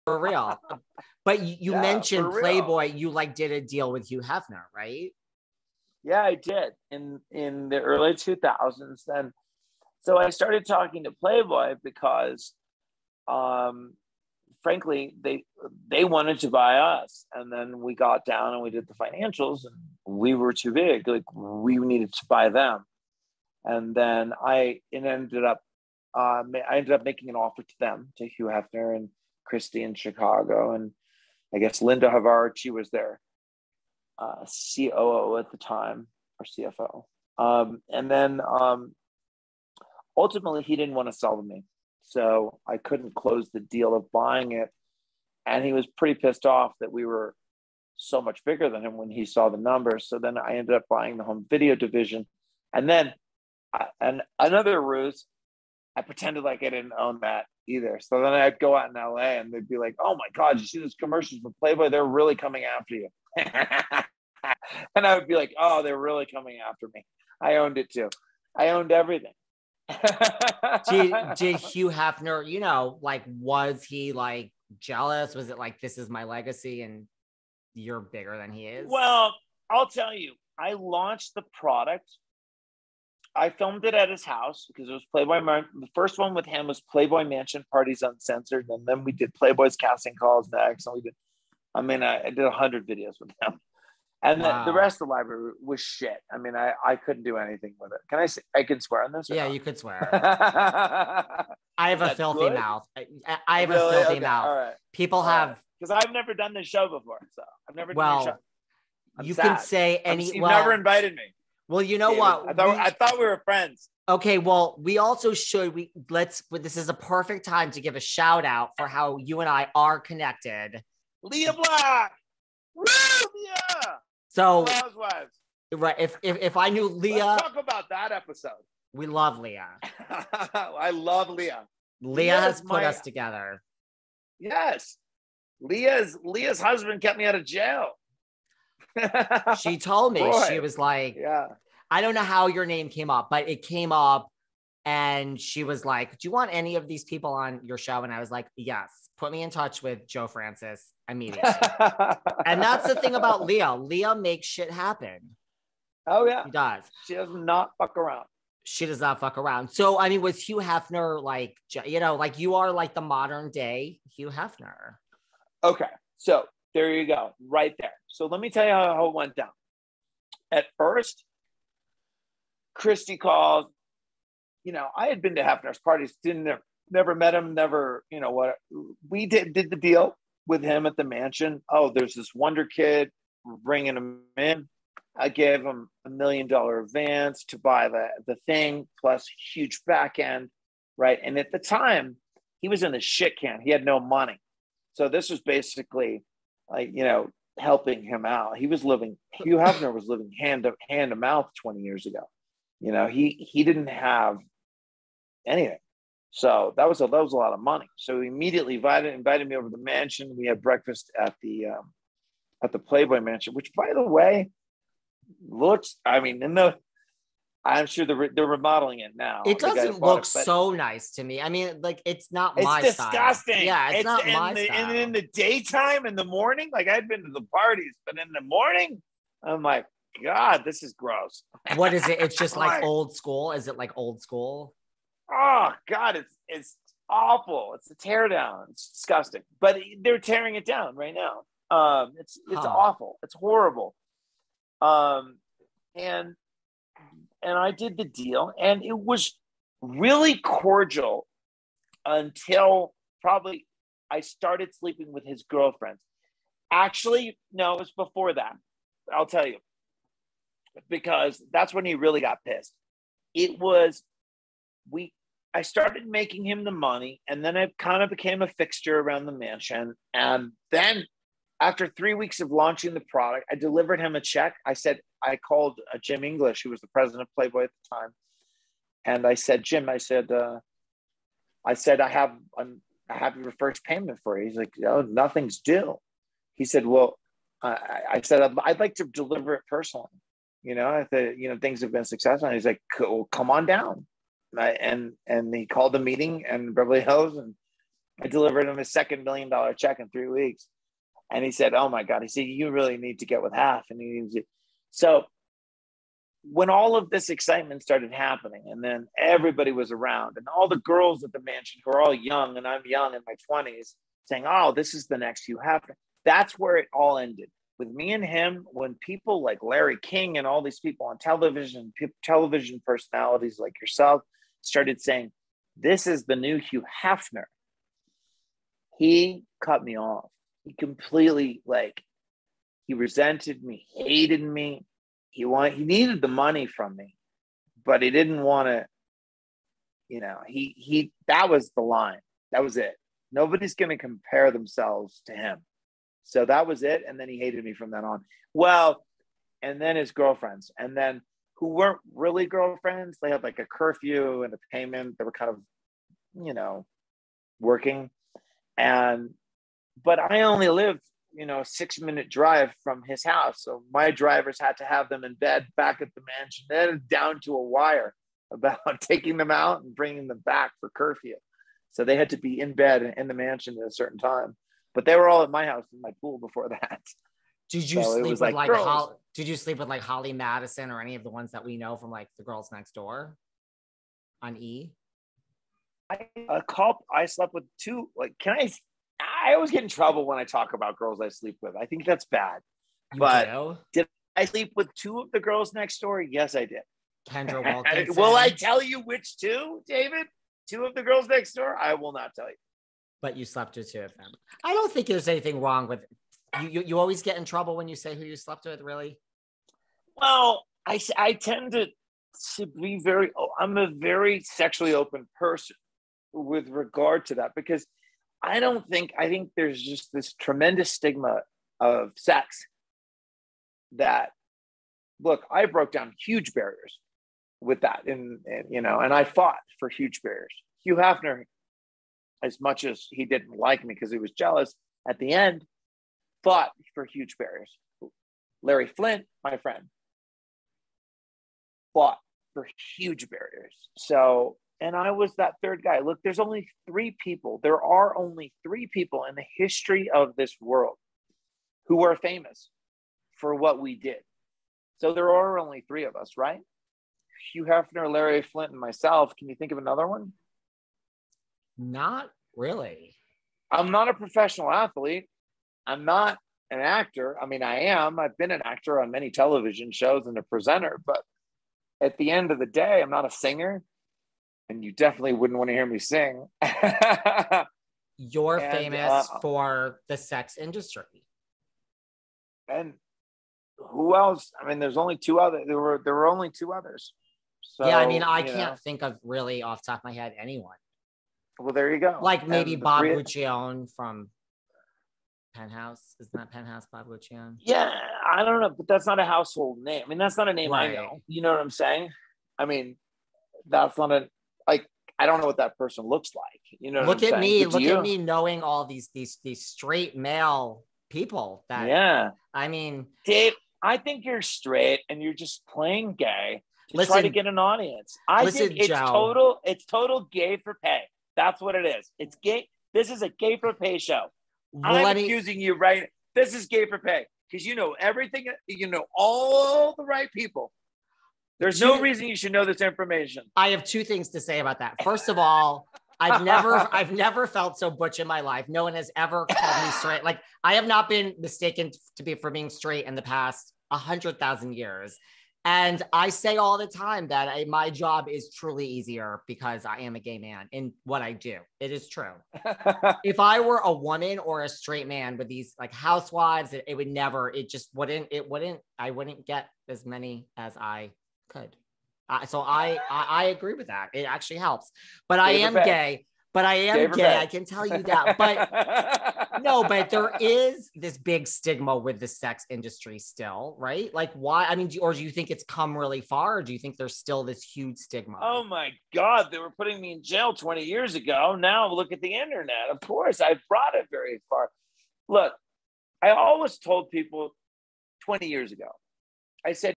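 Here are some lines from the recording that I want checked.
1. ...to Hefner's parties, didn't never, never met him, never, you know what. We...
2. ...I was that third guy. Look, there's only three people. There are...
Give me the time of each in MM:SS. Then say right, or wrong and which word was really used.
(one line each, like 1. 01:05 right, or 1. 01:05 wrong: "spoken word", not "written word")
1. 02:55 right
2. 07:24 right.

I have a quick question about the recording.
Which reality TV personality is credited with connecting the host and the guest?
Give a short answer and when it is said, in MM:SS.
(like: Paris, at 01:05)
Lea Black, at 02:01.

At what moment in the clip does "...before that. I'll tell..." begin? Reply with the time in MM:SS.
04:17.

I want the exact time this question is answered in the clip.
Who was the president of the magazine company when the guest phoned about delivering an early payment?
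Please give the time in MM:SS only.
04:36.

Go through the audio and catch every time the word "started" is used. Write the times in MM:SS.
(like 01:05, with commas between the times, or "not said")
00:10, 04:14, 04:25, 05:07, 05:24.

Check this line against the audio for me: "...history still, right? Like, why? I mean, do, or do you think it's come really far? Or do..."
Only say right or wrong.
wrong.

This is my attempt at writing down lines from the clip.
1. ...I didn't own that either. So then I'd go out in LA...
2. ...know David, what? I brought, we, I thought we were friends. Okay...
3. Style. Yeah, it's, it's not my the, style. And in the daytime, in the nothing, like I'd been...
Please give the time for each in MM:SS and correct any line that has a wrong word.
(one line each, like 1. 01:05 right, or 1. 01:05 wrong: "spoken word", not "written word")
1. 00:56 right
2. 01:51 wrong: "thought", not "brought"
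3. 03:43 wrong: "morning", not "nothing".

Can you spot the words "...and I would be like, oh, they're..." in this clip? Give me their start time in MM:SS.
01:03.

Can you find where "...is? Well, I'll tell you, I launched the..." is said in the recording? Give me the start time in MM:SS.
01:18.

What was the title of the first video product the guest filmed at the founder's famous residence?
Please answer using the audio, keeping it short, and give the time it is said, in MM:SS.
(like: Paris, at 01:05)
Playboy Mansion Parties Uncensored, at 01:26.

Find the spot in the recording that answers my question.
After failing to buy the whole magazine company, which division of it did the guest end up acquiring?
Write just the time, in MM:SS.
00:51.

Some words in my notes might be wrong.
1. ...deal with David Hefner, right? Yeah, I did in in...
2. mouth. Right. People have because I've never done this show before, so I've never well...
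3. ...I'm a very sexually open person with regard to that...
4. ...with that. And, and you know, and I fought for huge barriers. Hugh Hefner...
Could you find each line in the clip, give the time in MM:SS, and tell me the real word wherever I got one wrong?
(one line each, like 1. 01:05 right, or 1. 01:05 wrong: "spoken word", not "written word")
1. 00:03 wrong: "Hugh", not "David"
2. 01:44 right
3. 06:53 right
4. 07:07 right.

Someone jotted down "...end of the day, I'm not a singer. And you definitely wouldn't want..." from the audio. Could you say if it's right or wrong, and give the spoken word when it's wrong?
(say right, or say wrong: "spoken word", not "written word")
right.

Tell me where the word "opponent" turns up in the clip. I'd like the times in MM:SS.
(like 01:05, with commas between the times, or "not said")
not said.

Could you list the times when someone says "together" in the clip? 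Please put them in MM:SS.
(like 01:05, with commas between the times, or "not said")
02:12.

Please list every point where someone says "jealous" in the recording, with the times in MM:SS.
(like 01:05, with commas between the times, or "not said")
01:14, 07:14.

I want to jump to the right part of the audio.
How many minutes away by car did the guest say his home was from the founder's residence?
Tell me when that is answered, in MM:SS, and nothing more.
06:01.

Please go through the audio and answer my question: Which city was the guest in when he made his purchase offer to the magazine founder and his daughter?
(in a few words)
Chicago.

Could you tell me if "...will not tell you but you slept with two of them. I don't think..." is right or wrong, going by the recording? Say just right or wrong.
right.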